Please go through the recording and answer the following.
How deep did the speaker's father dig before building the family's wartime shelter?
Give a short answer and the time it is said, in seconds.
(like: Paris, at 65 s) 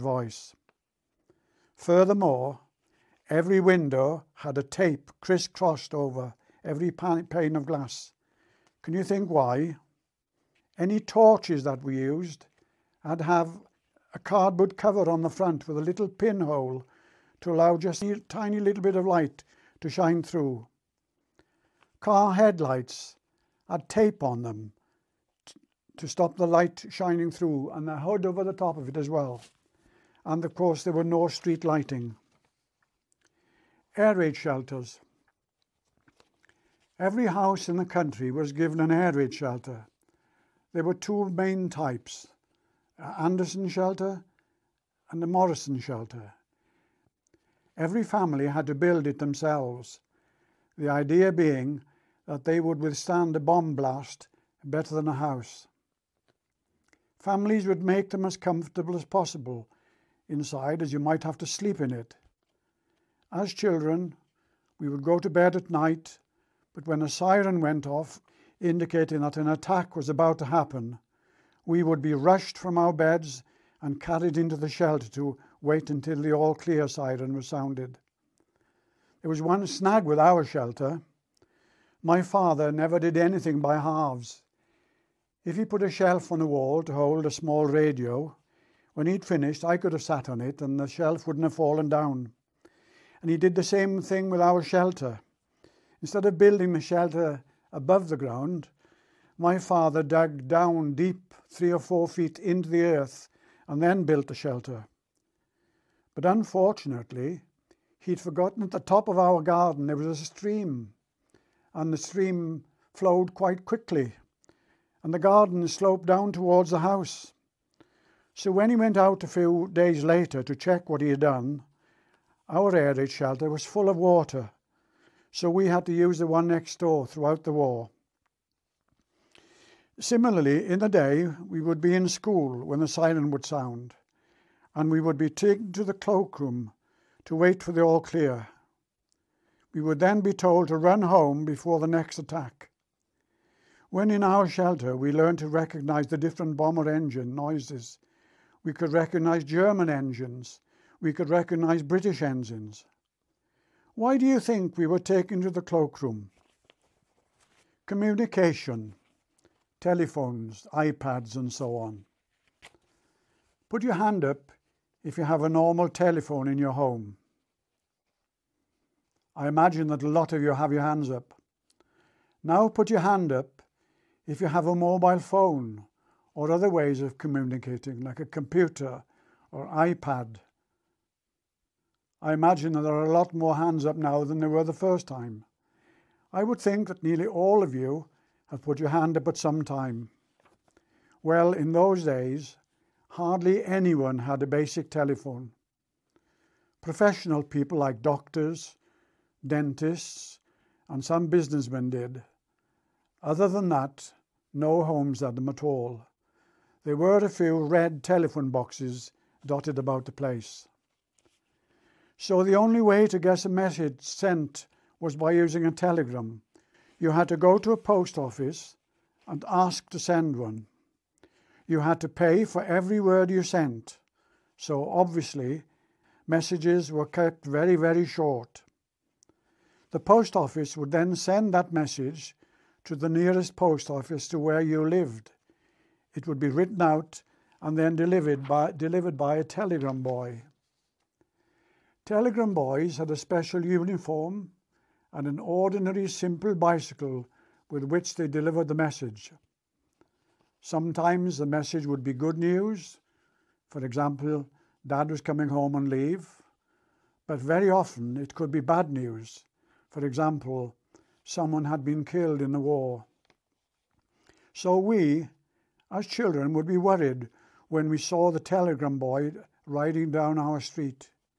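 3 or 4 feet, at 101 s.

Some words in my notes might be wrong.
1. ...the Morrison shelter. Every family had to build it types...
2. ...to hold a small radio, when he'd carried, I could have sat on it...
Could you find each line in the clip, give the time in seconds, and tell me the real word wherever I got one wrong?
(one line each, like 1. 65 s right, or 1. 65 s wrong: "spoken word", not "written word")
1. 45 s wrong: "themselves", not "types"
2. 86 s wrong: "finished", not "carried".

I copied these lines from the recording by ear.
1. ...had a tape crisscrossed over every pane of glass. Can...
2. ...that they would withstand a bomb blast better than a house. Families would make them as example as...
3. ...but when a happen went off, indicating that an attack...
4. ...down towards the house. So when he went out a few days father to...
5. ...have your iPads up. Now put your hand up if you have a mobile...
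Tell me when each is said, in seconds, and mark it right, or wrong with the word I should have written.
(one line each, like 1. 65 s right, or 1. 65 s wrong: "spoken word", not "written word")
1. 4 s right
2. 52 s wrong: "comfortable", not "example"
3. 66 s wrong: "siren", not "happen"
4. 116 s wrong: "later", not "father"
5. 170 s wrong: "hands", not "iPads".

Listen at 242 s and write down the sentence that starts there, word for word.
Telegram boys had a special uniform and an ordinary simple bicycle with which they delivered the message.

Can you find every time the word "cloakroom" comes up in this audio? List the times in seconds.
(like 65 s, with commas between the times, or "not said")
135 s, 155 s.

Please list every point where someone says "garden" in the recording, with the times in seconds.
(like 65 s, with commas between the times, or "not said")
109 s, 115 s.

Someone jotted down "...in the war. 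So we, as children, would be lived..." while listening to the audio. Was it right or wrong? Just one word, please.
wrong.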